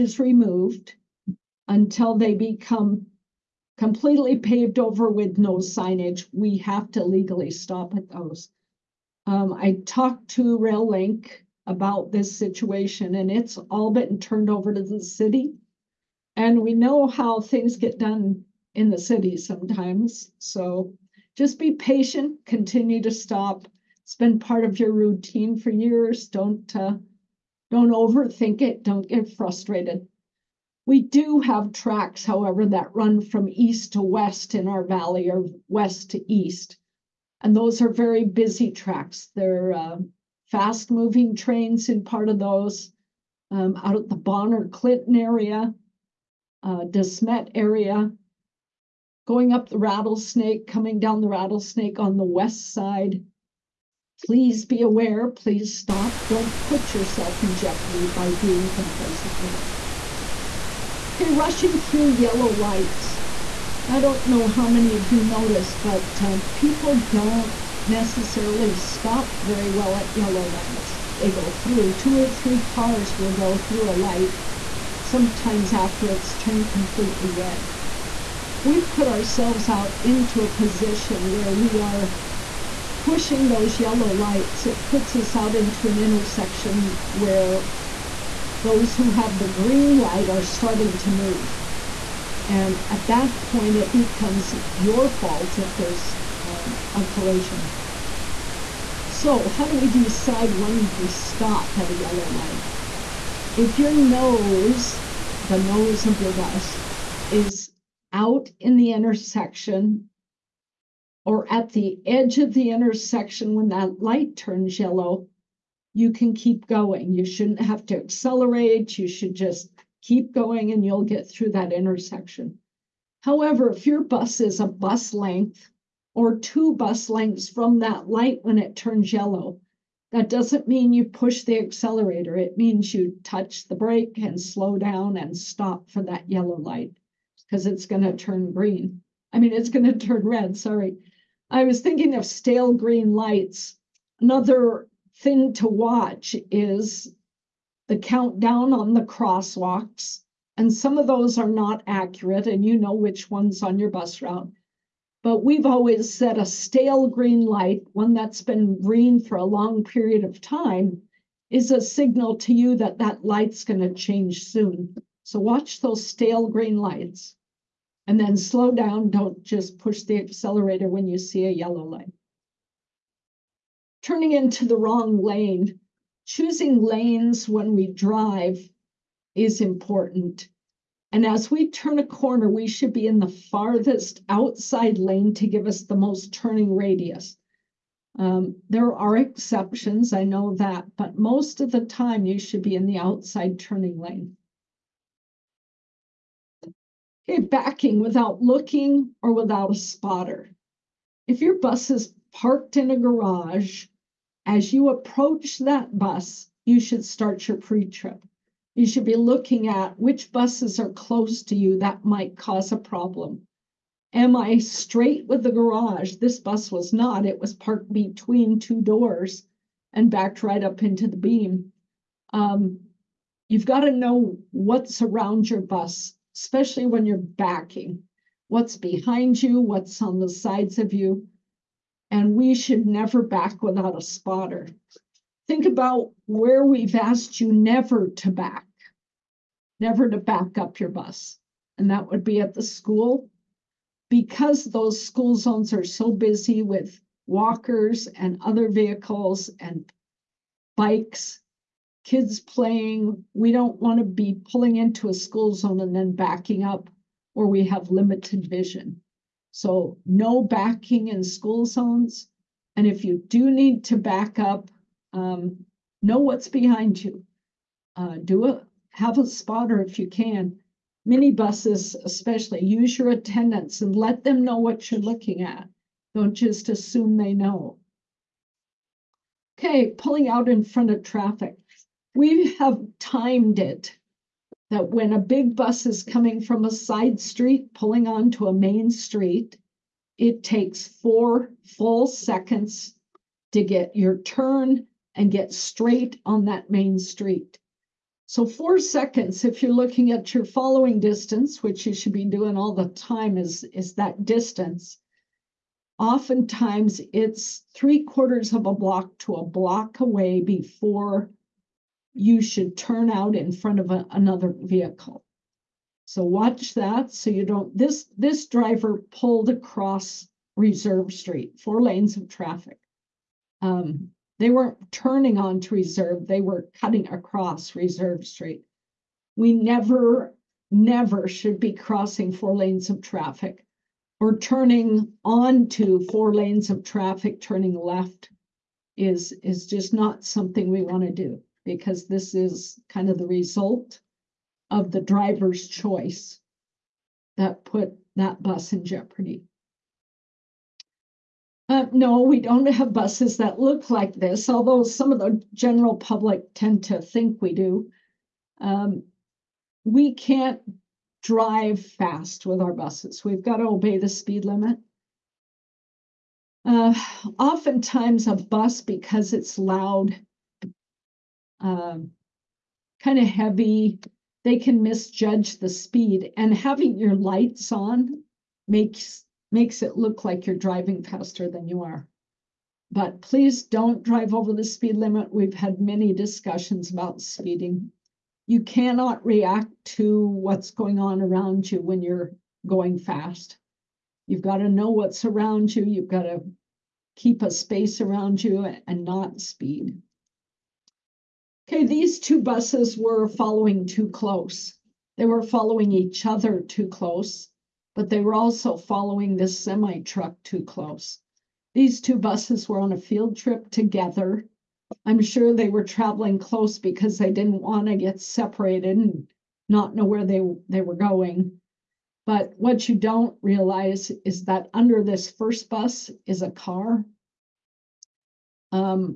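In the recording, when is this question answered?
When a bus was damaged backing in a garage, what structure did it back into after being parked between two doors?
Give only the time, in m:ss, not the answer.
3:41.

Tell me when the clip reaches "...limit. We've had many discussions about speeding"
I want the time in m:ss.
6:24.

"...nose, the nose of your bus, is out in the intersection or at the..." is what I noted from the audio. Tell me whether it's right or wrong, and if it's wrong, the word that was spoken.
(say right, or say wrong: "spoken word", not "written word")
right.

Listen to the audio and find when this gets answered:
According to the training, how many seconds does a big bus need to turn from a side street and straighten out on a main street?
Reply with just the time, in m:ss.
4:50.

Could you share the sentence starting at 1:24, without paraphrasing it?
It puts us out into an intersection where those who have the green light are starting to move.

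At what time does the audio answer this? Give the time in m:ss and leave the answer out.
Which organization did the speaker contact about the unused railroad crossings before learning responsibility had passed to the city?
0:10.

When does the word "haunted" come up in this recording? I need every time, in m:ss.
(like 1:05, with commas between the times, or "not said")
not said.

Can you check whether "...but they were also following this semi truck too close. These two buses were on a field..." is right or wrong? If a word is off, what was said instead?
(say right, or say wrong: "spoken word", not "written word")
right.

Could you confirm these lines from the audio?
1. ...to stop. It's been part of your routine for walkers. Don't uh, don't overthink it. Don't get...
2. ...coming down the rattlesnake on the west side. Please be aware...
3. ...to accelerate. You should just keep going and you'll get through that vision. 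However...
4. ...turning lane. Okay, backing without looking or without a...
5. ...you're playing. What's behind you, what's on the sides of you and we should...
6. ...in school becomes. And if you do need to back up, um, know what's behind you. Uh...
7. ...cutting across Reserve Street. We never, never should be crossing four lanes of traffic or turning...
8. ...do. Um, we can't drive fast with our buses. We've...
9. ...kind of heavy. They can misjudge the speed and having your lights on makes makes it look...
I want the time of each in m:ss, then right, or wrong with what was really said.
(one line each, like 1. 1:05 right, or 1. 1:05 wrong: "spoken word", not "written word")
1. 0:23 wrong: "years", not "walkers"
2. 0:50 right
3. 1:57 wrong: "intersection", not "vision"
4. 3:13 right
5. 3:47 wrong: "backing", not "playing"
6. 4:21 wrong: "zones", not "becomes"
7. 5:26 right
8. 5:57 right
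9. 6:12 right.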